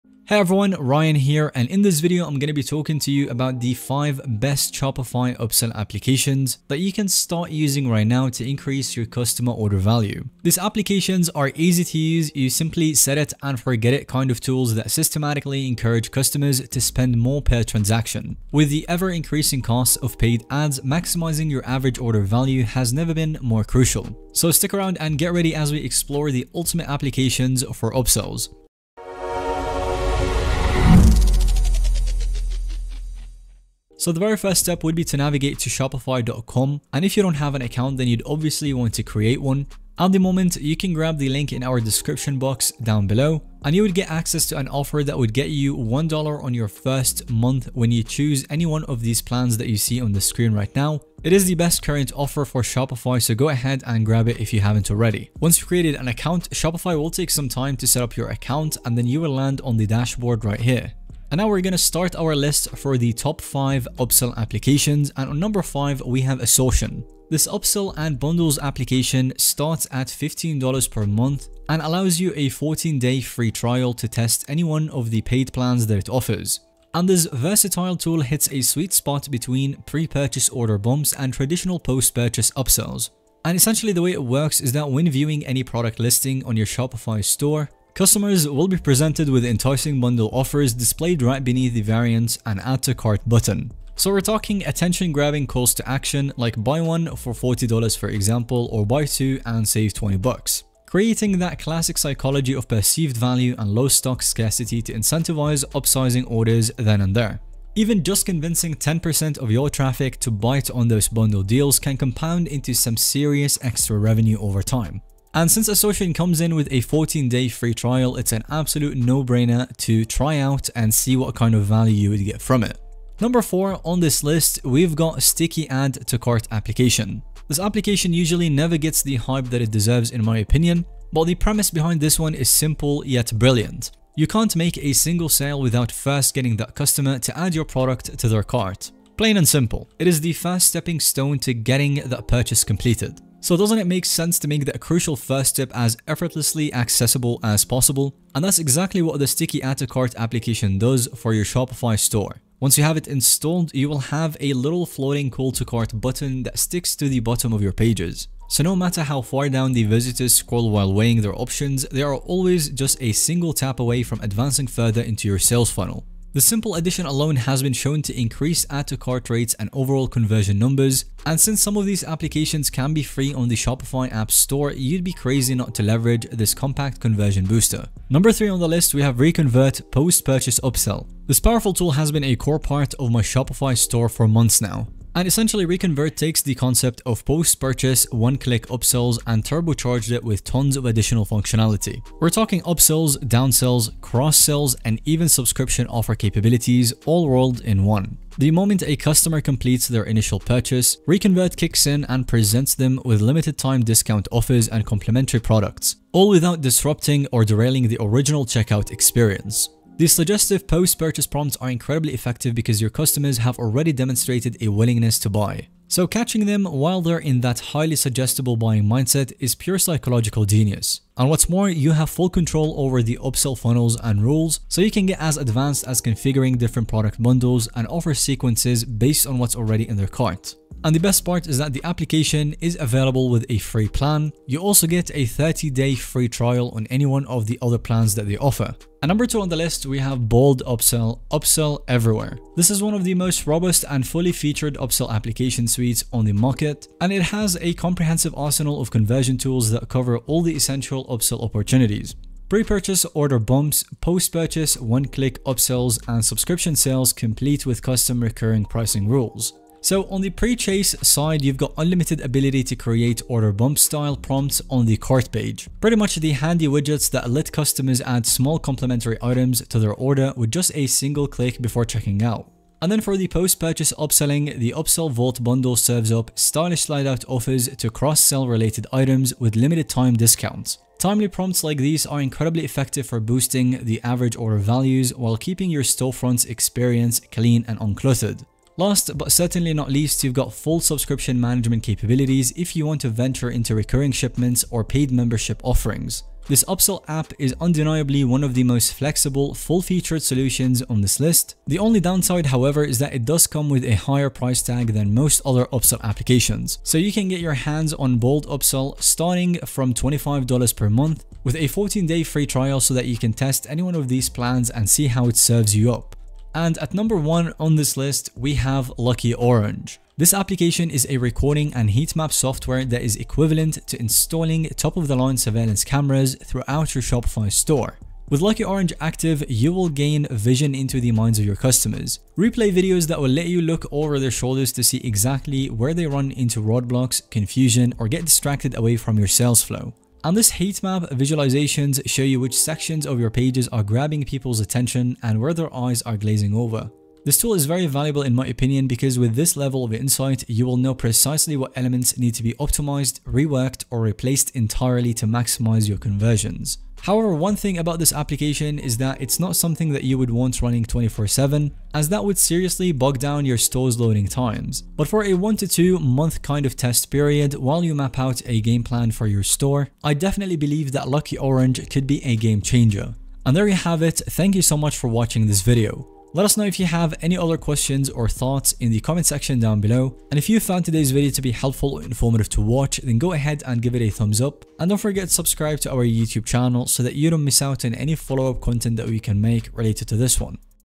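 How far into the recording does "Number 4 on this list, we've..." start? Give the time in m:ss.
2:03.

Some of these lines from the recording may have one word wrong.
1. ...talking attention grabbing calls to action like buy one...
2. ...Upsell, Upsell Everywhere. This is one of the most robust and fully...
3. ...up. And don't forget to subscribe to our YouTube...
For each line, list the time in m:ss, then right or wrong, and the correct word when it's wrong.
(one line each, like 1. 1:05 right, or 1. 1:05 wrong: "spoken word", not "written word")
1. 1:34 right
2. 4:00 right
3. 6:24 right.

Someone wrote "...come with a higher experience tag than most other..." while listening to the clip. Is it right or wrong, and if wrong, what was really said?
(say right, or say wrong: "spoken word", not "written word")
wrong: "price", not "experience".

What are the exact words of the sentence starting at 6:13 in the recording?
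And there you have it, thank you so much for watching this video.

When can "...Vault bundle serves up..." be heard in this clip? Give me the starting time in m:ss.
4:35.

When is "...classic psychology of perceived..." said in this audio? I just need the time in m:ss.
1:41.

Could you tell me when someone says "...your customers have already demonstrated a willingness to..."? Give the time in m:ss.
3:32.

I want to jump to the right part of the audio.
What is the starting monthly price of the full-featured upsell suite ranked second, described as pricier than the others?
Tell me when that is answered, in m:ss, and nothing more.
5:09.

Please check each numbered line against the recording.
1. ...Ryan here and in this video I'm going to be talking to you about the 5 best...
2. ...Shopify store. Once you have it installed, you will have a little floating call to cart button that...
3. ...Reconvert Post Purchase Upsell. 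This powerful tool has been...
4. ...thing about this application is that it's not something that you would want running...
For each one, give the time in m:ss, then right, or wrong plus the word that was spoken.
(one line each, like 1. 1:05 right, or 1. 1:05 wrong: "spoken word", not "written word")
1. 0:00 right
2. 2:31 right
3. 2:59 right
4. 5:57 right.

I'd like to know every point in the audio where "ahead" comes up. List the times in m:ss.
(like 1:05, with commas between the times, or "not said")
0:53, 6:23.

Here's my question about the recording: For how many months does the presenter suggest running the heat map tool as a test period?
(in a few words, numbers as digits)
1 to 2 months.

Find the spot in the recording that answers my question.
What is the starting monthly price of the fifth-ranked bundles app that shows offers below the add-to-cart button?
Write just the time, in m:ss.
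1:10.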